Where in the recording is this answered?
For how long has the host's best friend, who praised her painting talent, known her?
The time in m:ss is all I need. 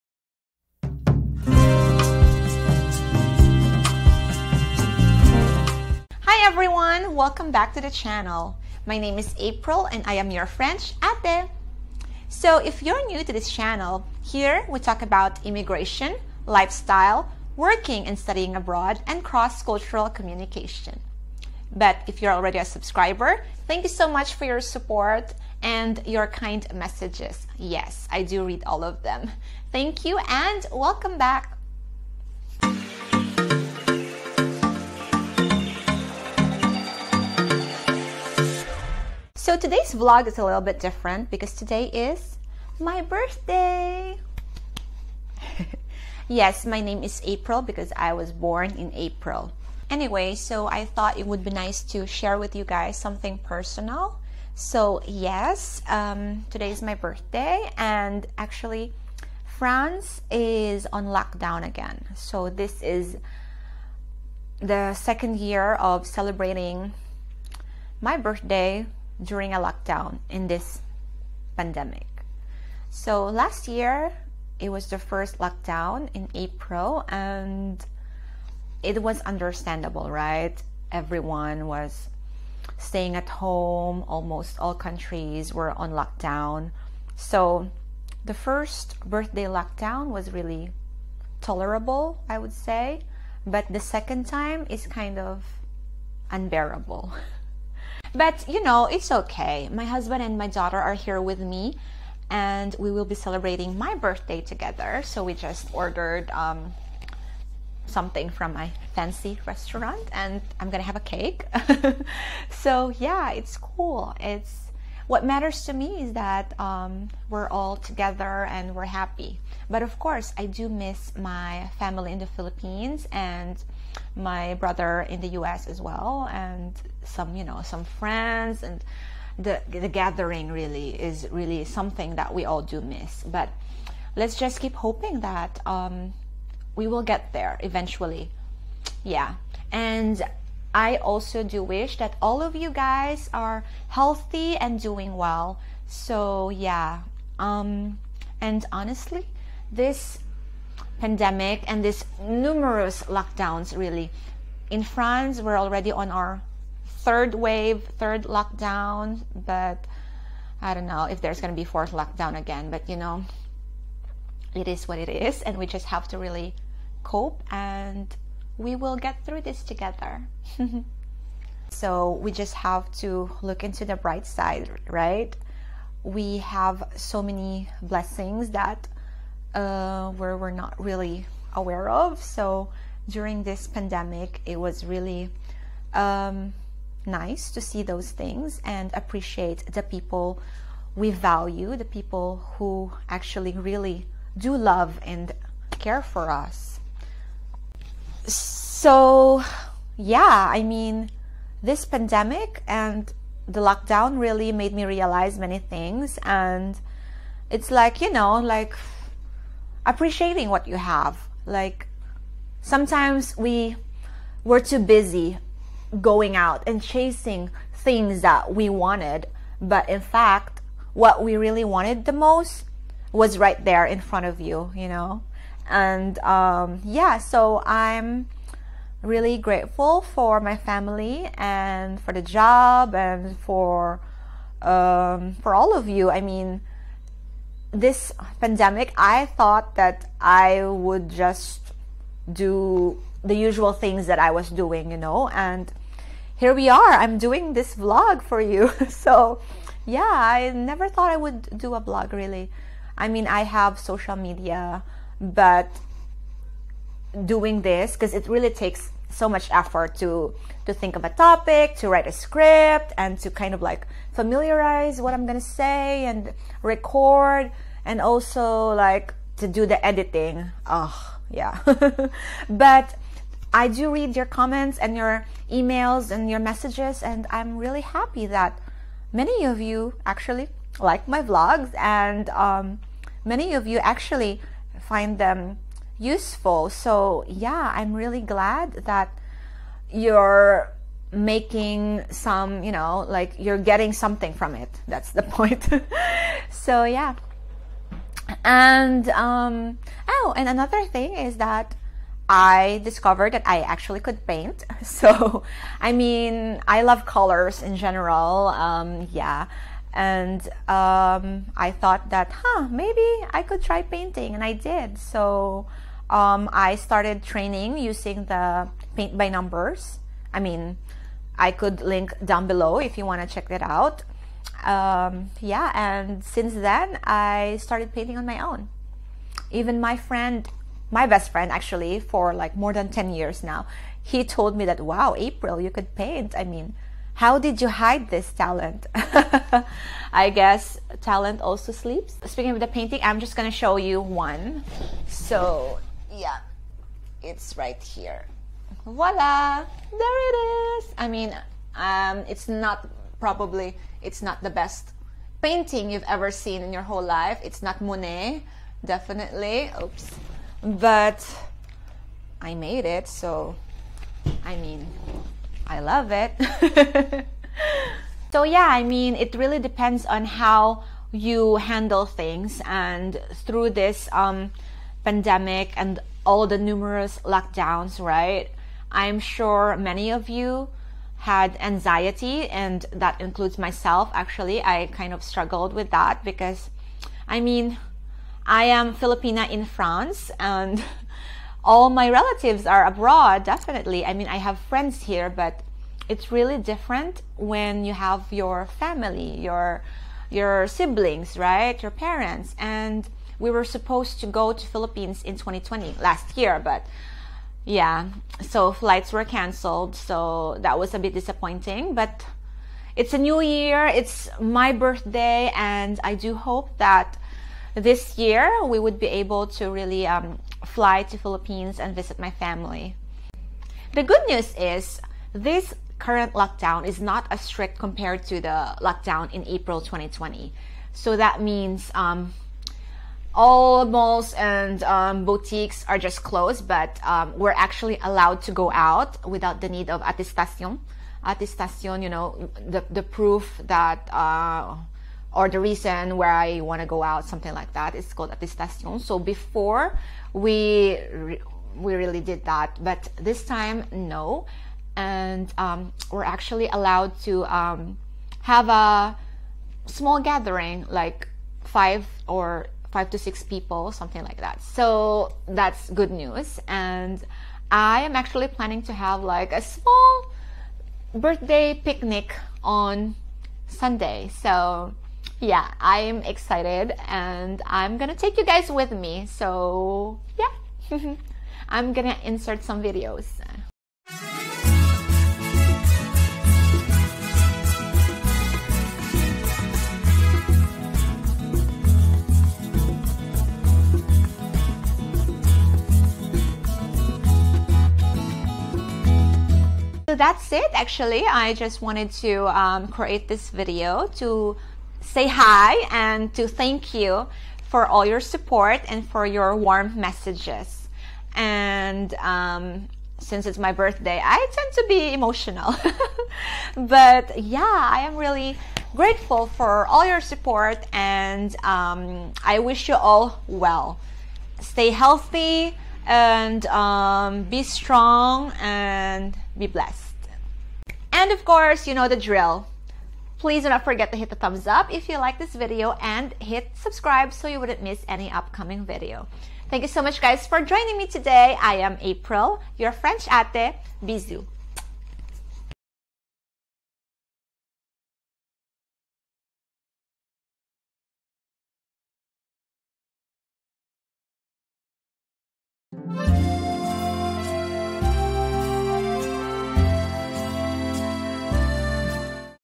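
5:32.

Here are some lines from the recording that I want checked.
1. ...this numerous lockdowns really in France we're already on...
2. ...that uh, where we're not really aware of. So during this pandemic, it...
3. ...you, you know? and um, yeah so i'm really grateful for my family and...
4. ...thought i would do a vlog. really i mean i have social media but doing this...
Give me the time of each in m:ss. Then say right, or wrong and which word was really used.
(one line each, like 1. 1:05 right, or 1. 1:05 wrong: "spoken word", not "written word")
1. 2:31 right
2. 2:58 right
3. 3:44 right
4. 4:10 right.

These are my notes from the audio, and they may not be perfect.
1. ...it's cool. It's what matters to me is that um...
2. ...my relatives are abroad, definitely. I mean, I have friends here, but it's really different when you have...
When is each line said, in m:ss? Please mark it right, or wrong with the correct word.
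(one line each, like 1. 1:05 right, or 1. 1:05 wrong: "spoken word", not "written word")
1. 1:53 right
2. 6:31 right.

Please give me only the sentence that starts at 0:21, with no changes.
But if you're already a subscriber, thank you so much for your support and your kind messages.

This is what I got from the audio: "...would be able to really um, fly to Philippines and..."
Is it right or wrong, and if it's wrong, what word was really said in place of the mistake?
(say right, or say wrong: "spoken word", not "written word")
right.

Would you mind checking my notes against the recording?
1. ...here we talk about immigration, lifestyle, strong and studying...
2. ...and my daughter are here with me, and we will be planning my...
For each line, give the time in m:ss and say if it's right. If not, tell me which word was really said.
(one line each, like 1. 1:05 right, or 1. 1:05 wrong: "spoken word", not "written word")
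1. 0:14 wrong: "working", not "strong"
2. 1:40 wrong: "celebrating", not "planning".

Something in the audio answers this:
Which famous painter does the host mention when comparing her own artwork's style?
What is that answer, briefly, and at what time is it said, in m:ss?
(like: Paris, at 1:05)
Monet, at 5:57.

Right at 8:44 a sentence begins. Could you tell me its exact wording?
Stay healthy and um, be strong and be blessed.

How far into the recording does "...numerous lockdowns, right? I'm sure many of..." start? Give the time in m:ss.
6:16.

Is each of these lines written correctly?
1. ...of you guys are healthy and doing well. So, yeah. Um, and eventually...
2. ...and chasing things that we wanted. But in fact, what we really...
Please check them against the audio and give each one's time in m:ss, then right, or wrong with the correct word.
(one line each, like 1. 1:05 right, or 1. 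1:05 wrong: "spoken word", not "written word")
1. 2:22 wrong: "honestly", not "eventually"
2. 3:36 right.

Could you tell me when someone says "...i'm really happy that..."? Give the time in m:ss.
4:37.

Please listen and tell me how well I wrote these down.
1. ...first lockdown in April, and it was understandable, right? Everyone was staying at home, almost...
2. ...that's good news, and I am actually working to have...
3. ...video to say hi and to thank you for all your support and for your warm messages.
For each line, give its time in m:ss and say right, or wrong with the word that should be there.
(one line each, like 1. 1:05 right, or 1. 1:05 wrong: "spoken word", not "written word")
1. 1:14 right
2. 7:45 wrong: "planning", not "working"
3. 8:23 right.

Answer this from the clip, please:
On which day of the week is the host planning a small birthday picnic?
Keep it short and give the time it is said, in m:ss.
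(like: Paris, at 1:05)
Sunday, at 7:53.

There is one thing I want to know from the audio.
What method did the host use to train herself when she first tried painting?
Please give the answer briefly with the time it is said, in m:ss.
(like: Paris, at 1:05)
paint by numbers, at 5:18.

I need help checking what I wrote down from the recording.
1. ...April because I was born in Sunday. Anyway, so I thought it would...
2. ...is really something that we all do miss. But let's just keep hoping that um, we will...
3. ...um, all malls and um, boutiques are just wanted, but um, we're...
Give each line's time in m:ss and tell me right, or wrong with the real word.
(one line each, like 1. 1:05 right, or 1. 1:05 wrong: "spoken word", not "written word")
1. 0:47 wrong: "April", not "Sunday"
2. 2:10 right
3. 7:11 wrong: "closed", not "wanted".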